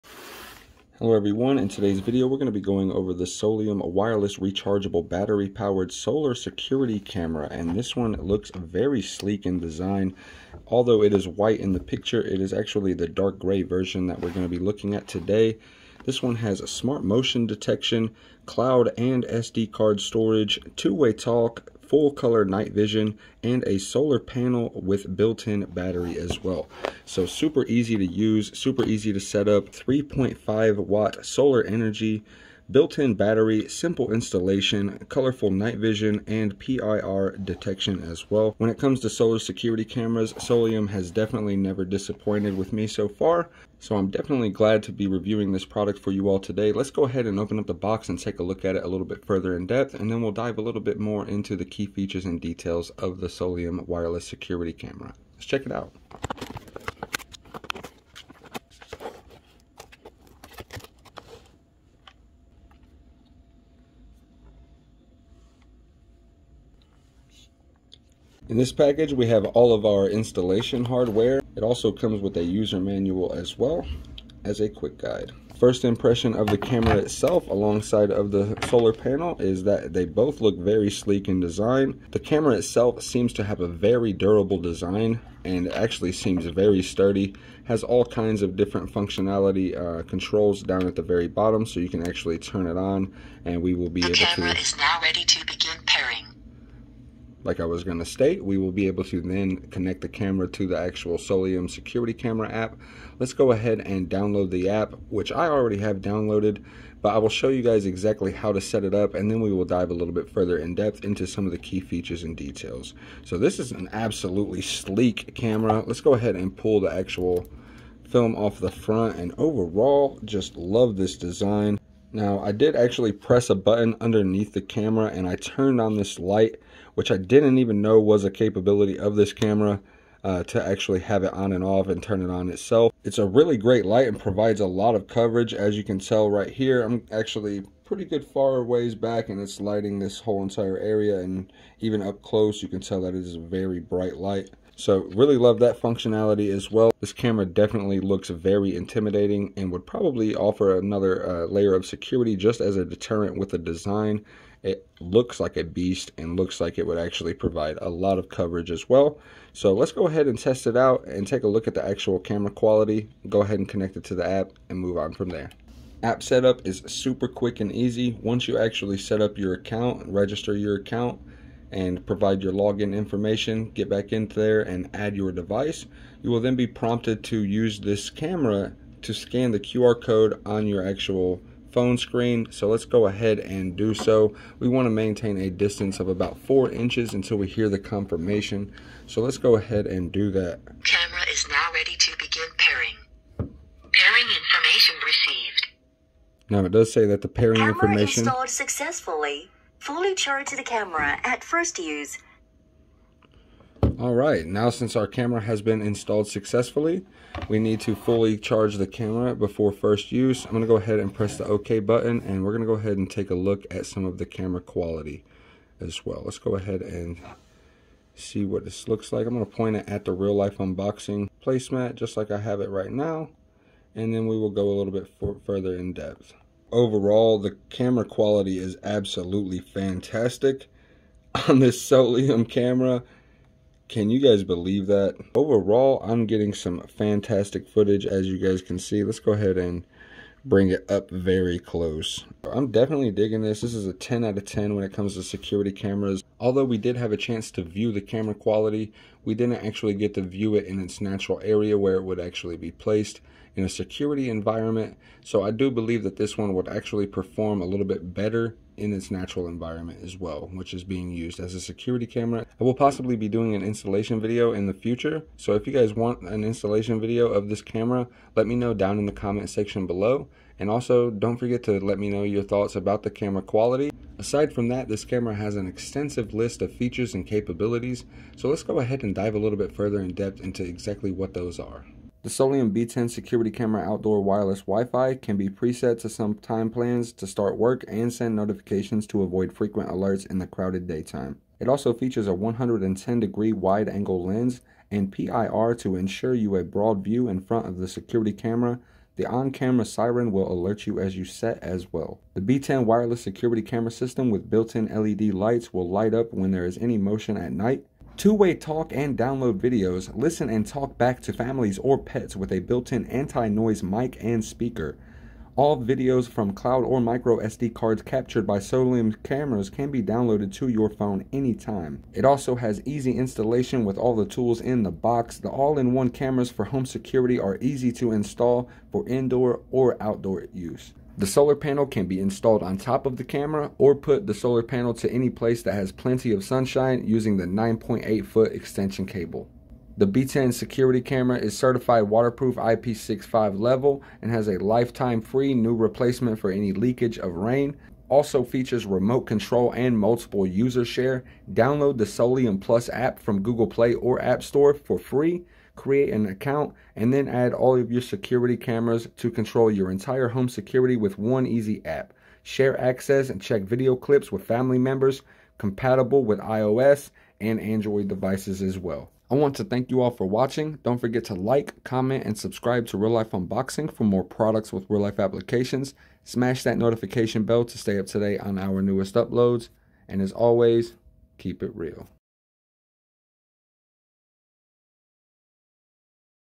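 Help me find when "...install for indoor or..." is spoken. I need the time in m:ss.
5:28.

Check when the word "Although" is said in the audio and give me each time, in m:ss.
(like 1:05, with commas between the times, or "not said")
0:10, 4:06.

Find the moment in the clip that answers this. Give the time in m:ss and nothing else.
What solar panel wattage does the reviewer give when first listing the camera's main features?
0:29.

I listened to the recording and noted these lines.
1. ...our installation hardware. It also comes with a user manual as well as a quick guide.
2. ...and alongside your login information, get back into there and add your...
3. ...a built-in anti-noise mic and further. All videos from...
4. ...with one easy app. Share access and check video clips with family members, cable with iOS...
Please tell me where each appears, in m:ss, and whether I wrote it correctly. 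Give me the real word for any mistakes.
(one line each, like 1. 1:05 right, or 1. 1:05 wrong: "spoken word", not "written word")
1. 1:09 right
2. 2:51 wrong: "provide", not "alongside"
3. 5:12 wrong: "speaker", not "further"
4. 6:00 wrong: "compatible", not "cable".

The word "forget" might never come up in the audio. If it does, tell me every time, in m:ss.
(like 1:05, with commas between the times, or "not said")
4:31, 6:10.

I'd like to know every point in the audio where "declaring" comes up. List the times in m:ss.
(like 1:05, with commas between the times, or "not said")
not said.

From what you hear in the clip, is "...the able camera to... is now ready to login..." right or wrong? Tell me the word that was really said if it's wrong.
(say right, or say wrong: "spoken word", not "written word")
wrong: "begin", not "login".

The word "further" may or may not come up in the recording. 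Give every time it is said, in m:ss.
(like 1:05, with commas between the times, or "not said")
0:49, 1:50, 3:45, 4:39.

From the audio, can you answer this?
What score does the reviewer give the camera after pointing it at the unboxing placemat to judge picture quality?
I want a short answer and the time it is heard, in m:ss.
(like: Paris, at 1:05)
10 out of 10, at 4:03.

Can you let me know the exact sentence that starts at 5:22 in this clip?
It also has easy installation with all the tools in the box.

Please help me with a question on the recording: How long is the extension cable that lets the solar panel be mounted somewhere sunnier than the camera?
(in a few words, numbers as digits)
9.8 feet.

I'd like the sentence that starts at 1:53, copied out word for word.
So this is an absolutely sleek camera.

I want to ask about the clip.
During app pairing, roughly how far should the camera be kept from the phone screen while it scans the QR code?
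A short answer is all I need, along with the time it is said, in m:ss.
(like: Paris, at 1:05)
4 inches, at 3:06.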